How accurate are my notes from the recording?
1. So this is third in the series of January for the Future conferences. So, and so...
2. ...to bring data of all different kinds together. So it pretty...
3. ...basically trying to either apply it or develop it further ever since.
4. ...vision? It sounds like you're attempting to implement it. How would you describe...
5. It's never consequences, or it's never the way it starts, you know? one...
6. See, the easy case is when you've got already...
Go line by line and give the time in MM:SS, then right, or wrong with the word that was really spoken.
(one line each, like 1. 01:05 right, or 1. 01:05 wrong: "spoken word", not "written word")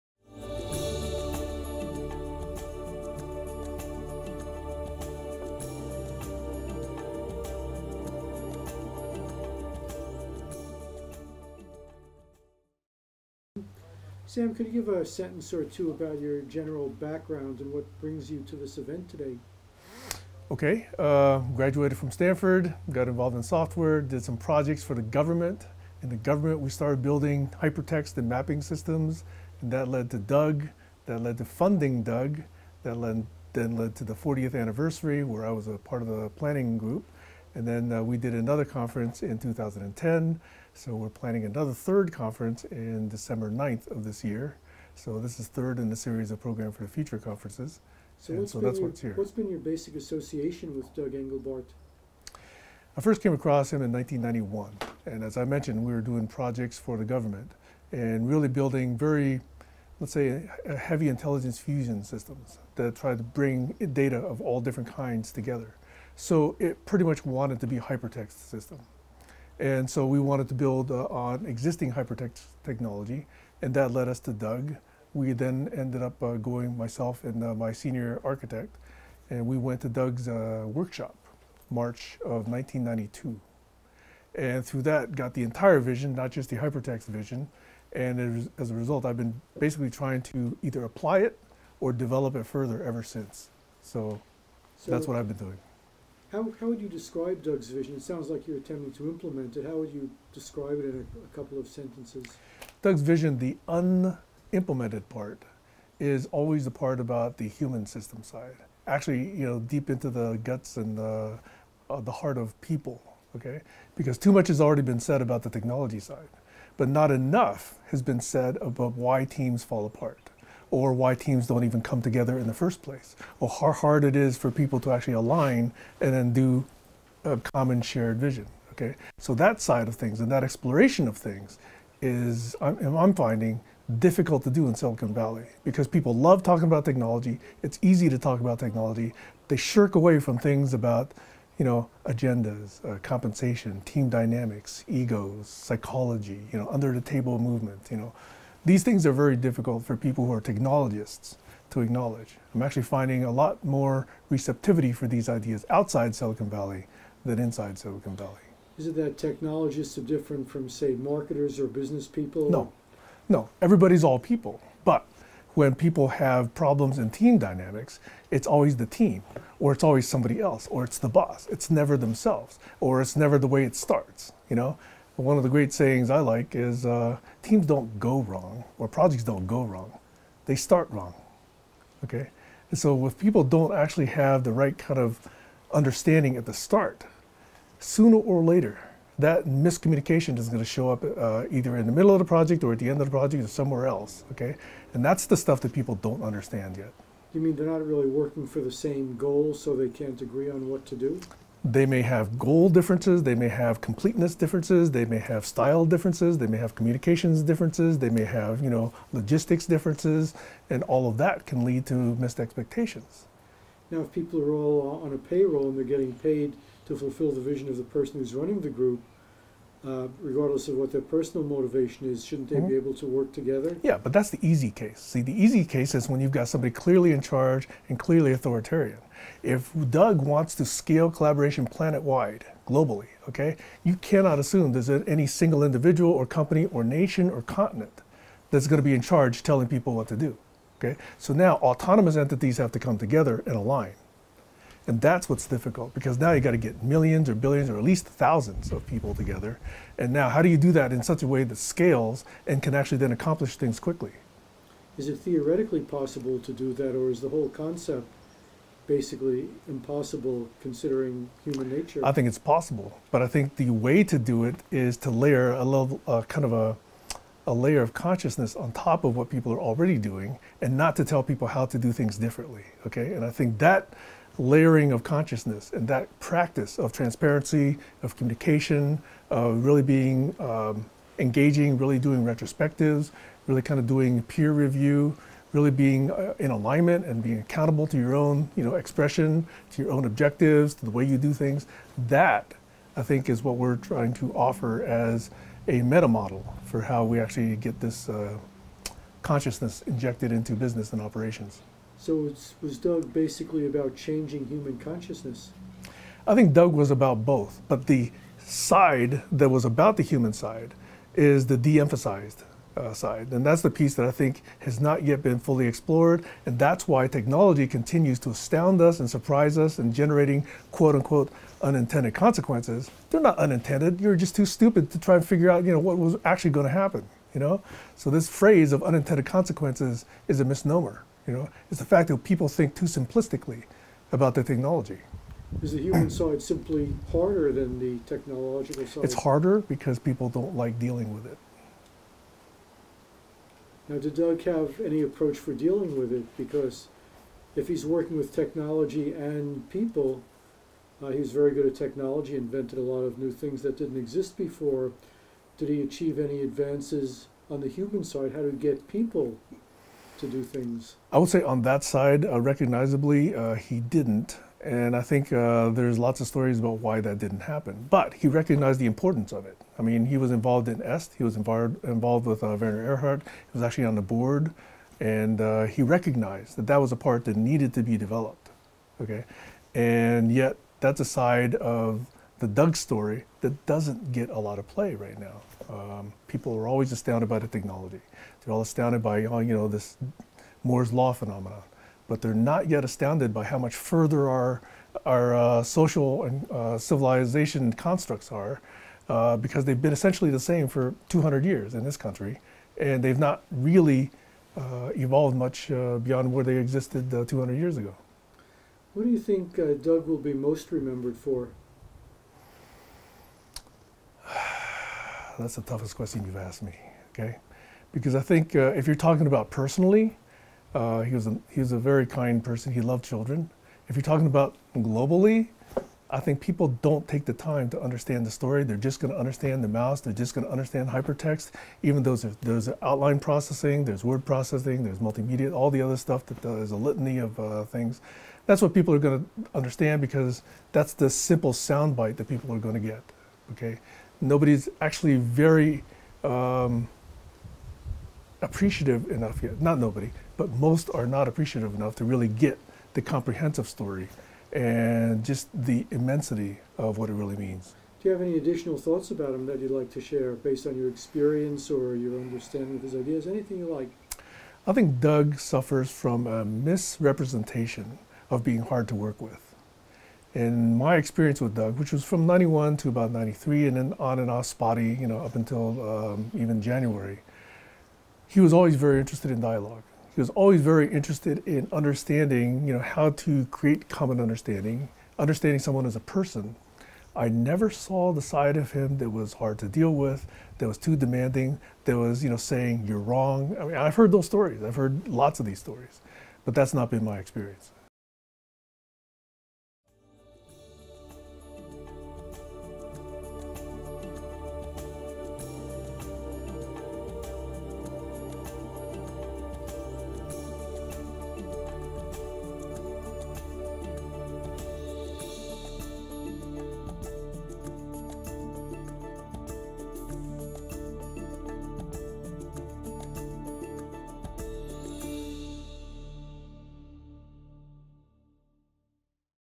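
1. 00:44 wrong: "Program", not "January"
2. 01:03 right
3. 01:29 right
4. 01:37 right
5. 02:51 wrong: "themselves", not "consequences"
6. 03:45 wrong: "somebody", not "already".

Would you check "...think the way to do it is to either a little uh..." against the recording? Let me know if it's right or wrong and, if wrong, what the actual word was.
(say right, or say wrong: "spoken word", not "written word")
wrong: "layer", not "either".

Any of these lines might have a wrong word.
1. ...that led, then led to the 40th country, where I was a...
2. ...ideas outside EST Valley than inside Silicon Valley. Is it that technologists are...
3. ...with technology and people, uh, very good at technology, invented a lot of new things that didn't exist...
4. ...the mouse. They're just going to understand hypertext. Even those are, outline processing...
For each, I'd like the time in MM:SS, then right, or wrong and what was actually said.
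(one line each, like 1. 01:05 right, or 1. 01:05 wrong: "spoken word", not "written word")
1. 00:32 wrong: "anniversary", not "country"
2. 02:35 wrong: "Silicon", not "EST"
3. 05:48 right
4. 07:09 right.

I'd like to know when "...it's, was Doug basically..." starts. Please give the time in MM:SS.
05:02.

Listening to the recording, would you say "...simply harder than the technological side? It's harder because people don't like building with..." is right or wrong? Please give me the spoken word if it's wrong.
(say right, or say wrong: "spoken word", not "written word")
wrong: "dealing", not "building".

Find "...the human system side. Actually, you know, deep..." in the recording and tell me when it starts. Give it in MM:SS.
01:47.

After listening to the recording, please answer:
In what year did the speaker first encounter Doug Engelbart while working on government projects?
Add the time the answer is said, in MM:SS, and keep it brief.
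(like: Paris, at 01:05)
1991, at 00:53.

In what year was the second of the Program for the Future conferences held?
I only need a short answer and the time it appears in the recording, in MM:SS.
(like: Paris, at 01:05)
2010, at 00:39.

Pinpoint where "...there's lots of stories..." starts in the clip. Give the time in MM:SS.
06:05.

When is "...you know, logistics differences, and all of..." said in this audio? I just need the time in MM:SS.
03:28.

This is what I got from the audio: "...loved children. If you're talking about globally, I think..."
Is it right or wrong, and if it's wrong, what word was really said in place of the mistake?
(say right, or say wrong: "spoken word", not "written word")
right.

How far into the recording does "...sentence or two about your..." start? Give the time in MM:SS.
00:15.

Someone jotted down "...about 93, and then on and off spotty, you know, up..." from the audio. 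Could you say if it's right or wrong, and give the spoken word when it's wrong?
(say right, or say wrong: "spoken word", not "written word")
right.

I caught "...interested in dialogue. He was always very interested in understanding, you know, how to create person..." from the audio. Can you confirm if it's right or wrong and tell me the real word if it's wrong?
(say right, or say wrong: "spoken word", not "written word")
wrong: "common", not "person".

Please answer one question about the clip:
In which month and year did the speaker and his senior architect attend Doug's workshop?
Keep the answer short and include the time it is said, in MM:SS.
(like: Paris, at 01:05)
March 1992, at 01:21.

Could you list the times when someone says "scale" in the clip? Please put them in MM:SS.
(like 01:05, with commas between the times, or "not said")
03:50, 04:11.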